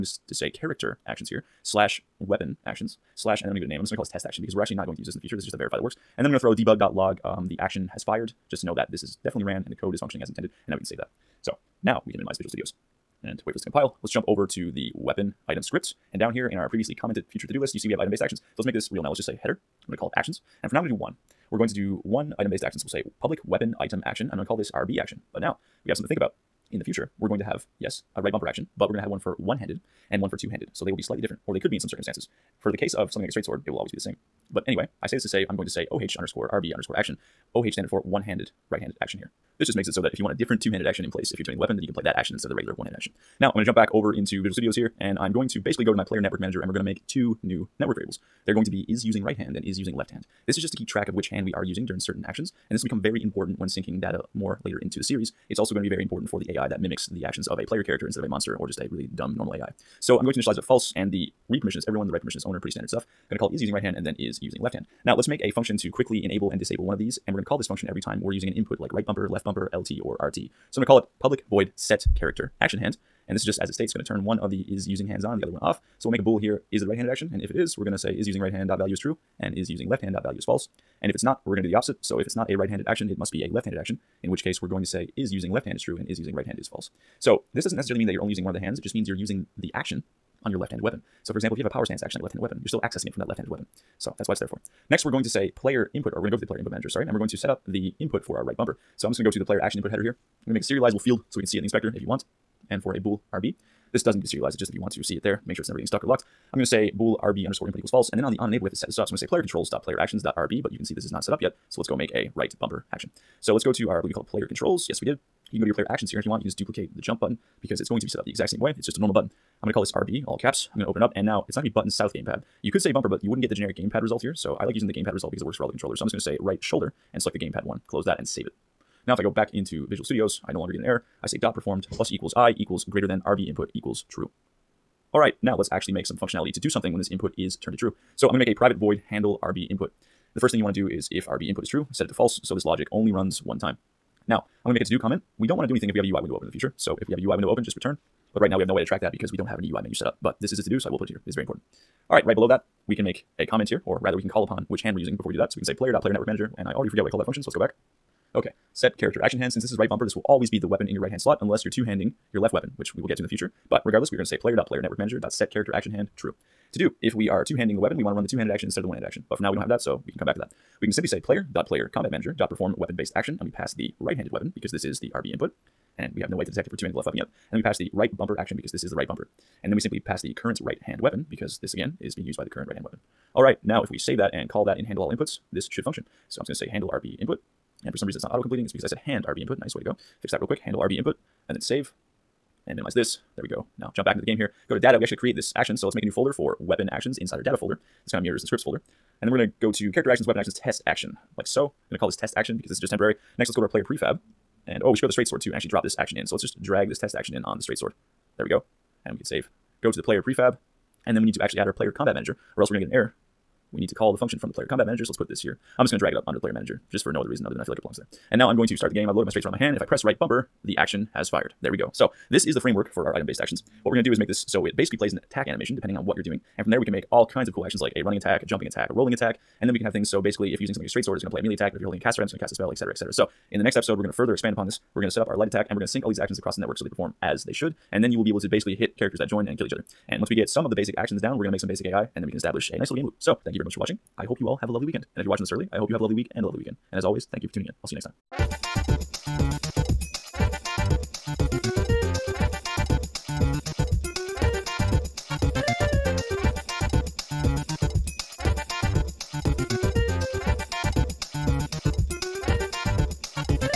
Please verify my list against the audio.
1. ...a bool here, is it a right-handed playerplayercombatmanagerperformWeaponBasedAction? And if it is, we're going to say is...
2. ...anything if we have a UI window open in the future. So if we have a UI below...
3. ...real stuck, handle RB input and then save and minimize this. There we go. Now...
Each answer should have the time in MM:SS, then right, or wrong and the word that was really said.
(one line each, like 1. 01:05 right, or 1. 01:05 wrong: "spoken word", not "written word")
1. 01:16 wrong: "action", not "playerplayercombatmanagerperformWeaponBasedAction"
2. 02:25 wrong: "window", not "below"
3. 03:10 wrong: "quick", not "stuck".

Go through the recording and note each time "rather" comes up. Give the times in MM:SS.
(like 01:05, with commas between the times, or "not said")
02:34.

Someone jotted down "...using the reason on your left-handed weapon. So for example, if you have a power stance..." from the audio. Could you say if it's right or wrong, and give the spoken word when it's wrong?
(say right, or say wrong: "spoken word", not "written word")
wrong: "action", not "reason".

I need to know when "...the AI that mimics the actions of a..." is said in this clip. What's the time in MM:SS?
00:56.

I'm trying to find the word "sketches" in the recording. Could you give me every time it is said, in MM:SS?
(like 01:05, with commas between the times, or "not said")
not said.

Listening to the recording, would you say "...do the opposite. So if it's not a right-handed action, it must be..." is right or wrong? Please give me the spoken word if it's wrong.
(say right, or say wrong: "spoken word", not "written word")
right.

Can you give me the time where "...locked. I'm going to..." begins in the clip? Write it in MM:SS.
01:46.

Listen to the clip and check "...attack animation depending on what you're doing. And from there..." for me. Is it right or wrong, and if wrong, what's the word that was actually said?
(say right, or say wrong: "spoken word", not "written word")
right.